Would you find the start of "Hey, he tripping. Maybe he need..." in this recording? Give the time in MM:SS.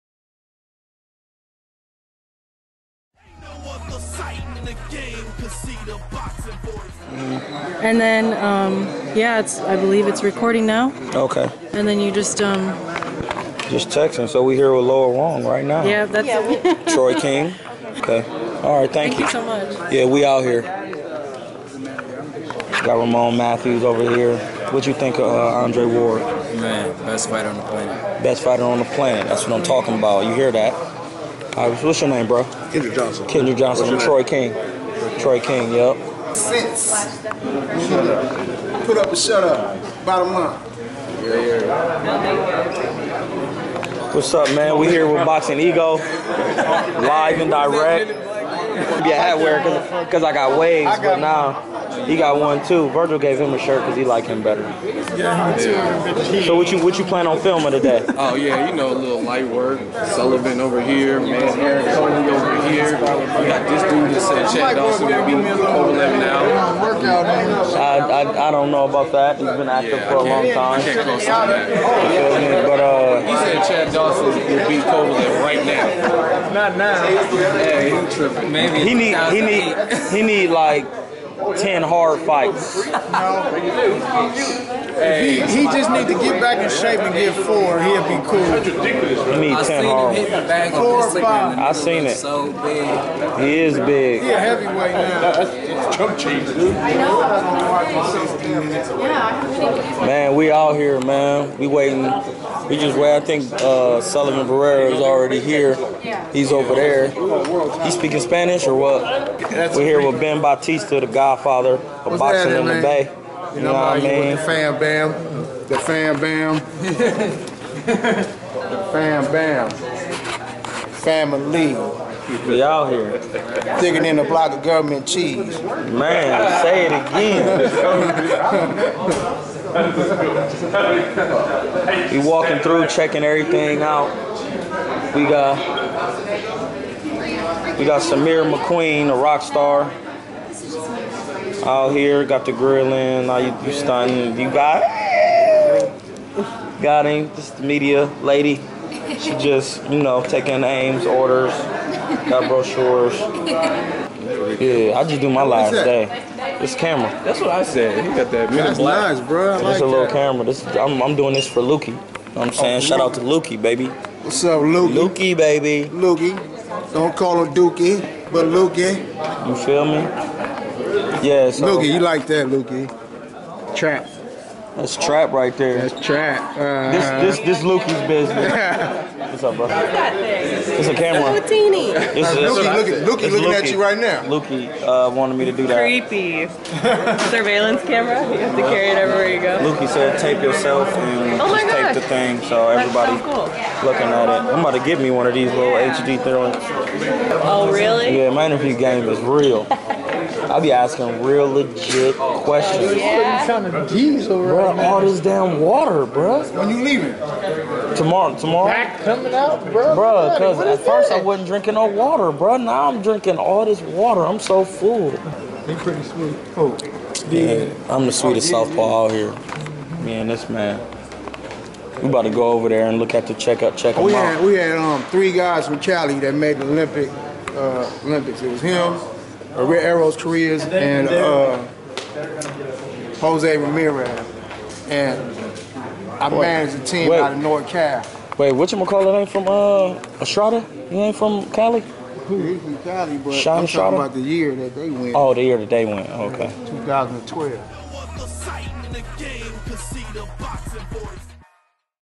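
01:17.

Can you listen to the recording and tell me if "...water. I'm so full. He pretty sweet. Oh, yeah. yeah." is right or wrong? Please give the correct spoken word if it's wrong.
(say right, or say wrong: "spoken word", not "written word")
right.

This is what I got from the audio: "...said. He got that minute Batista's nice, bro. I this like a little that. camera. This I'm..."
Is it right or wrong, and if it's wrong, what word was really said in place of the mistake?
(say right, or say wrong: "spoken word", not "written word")
wrong: "That", not "Batista".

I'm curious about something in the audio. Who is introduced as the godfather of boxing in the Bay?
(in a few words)
Ben Batista.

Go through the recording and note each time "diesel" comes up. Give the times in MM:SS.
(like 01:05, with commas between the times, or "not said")
03:23.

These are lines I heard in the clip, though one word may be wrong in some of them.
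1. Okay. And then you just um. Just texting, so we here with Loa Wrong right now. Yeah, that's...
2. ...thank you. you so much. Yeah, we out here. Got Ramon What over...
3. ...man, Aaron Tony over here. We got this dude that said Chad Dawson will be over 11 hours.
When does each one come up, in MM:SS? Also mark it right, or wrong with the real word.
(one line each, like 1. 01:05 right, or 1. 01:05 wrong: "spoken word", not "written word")
1. 00:11 right
2. 00:19 wrong: "Matthews", not "What"
3. 01:01 right.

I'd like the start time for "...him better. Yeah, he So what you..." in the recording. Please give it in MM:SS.
00:54.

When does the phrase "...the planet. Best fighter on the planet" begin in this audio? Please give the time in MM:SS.
00:27.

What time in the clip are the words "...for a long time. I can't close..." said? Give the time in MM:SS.
01:10.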